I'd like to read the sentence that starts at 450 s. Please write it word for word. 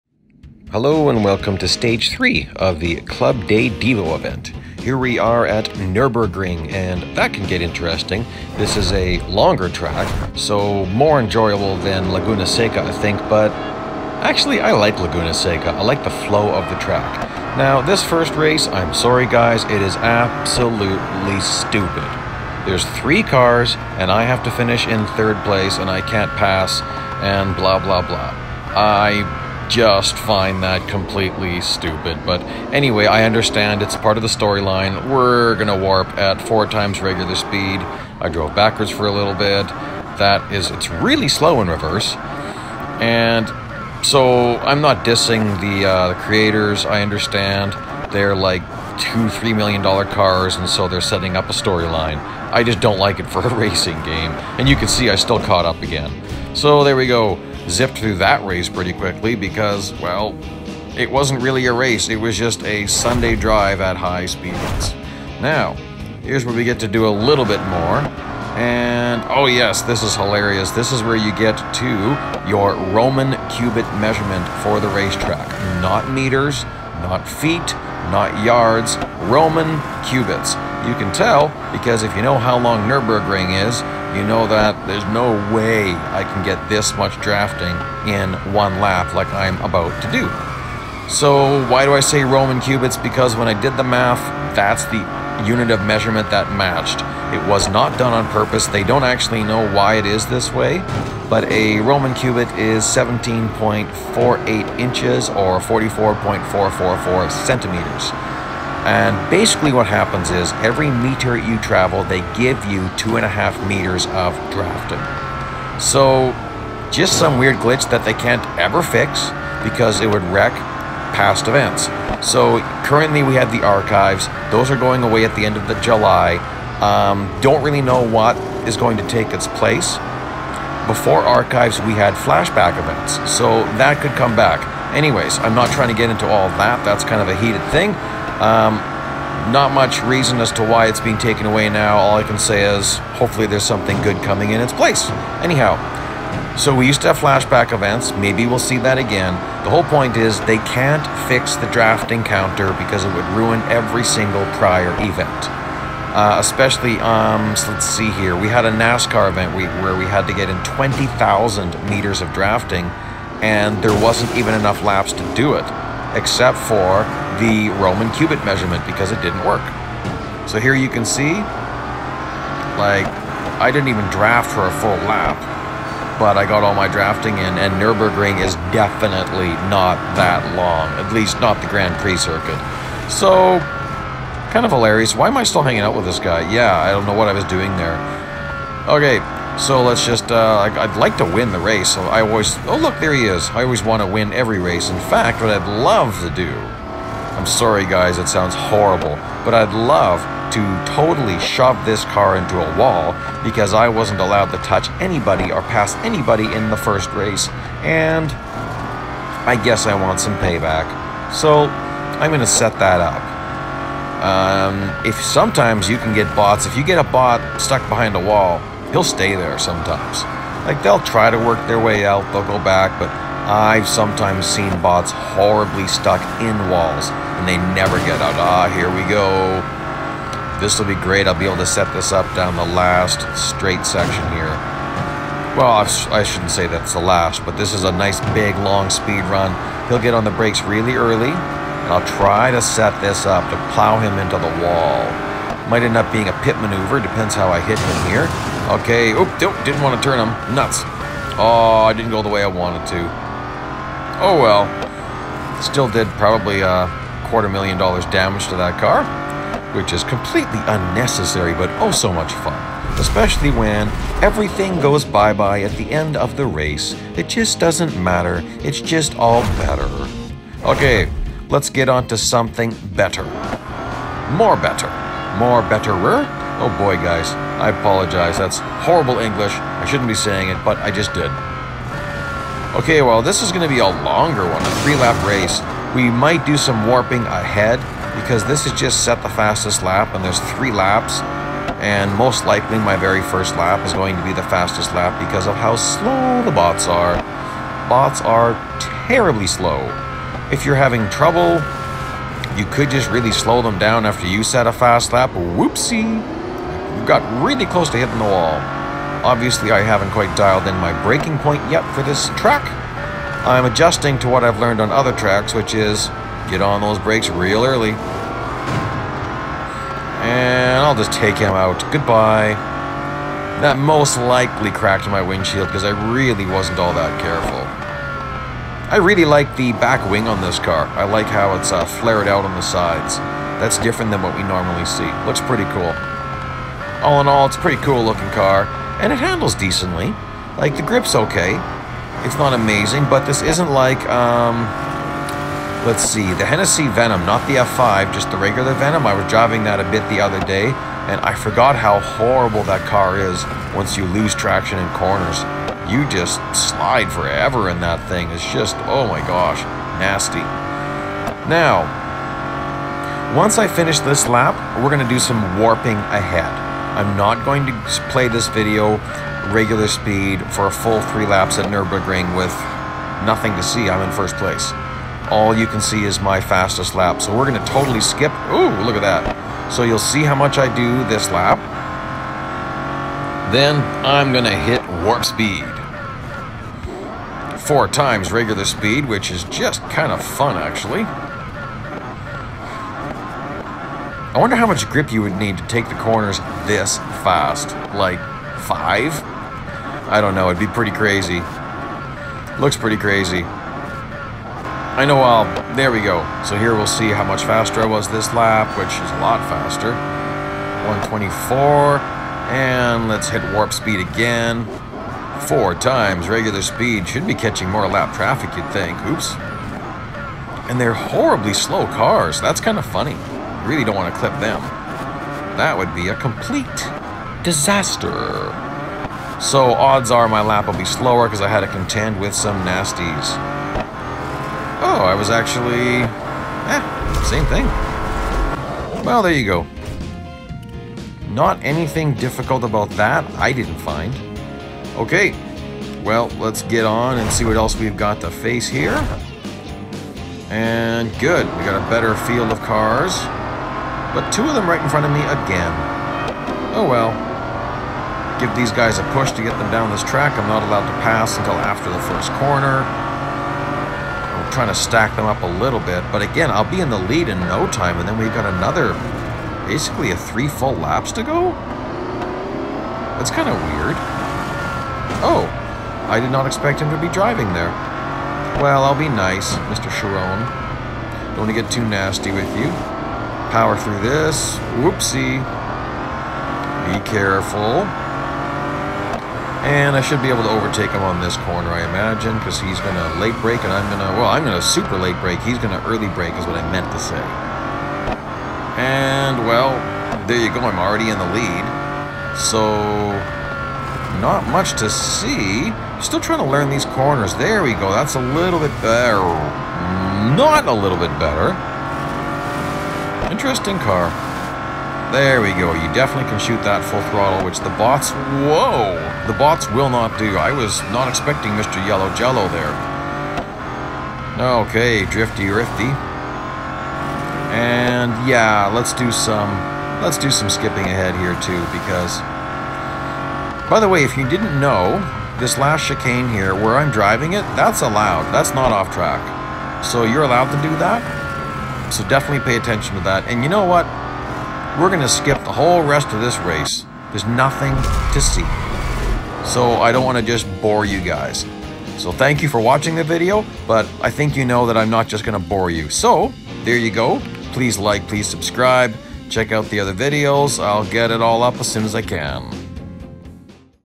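And good, we got a better field of cars.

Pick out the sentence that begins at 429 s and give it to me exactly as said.
So odds are my lap will be slower because I had to contend with some nasties.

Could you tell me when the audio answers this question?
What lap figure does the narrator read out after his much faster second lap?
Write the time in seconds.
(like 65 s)
411 s.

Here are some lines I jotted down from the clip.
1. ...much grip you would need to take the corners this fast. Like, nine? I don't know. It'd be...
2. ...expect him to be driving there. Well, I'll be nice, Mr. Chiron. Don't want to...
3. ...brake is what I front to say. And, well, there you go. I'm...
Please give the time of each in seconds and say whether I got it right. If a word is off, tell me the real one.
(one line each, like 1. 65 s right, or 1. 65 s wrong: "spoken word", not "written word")
1. 394 s wrong: "five", not "nine"
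2. 476 s right
3. 496 s wrong: "meant", not "front".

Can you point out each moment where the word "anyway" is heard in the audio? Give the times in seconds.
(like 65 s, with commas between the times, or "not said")
32 s, 134 s.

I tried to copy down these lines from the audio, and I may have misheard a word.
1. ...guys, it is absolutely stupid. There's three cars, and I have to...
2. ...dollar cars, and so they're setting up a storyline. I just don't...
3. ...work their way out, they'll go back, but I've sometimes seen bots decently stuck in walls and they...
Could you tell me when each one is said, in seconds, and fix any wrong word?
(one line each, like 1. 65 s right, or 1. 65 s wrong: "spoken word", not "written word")
1. 19 s right
2. 49 s right
3. 221 s wrong: "horribly", not "decently".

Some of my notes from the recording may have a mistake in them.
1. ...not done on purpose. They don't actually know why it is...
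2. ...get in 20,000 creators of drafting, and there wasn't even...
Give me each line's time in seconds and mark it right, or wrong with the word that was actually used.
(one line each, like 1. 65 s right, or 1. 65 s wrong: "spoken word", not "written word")
1. 97 s right
2. 160 s wrong: "meters", not "creators".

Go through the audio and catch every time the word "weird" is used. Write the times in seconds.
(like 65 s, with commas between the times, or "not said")
117 s, 473 s.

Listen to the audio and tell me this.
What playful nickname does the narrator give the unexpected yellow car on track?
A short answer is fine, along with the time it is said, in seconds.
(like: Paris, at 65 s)
Mr. Yellow Jello, at 521 s.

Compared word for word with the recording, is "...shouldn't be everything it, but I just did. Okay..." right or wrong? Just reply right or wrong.
wrong.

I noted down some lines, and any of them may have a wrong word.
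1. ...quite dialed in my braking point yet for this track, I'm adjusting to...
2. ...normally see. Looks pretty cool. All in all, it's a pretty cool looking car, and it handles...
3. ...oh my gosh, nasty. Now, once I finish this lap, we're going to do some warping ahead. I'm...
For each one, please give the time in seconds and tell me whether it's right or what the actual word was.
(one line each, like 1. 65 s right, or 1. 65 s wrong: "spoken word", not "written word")
1. 310 s right
2. 334 s right
3. 358 s right.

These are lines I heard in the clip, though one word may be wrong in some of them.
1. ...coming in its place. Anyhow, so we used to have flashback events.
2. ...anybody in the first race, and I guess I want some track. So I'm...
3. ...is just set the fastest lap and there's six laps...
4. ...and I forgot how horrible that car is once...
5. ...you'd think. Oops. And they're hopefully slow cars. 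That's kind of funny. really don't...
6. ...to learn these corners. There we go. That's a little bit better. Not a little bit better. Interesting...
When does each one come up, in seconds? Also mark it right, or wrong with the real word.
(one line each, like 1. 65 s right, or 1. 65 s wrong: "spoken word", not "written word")
1. 144 s right
2. 206 s wrong: "payback", not "track"
3. 288 s wrong: "three", not "six"
4. 351 s right
5. 418 s wrong: "horribly", not "hopefully"
6. 506 s right.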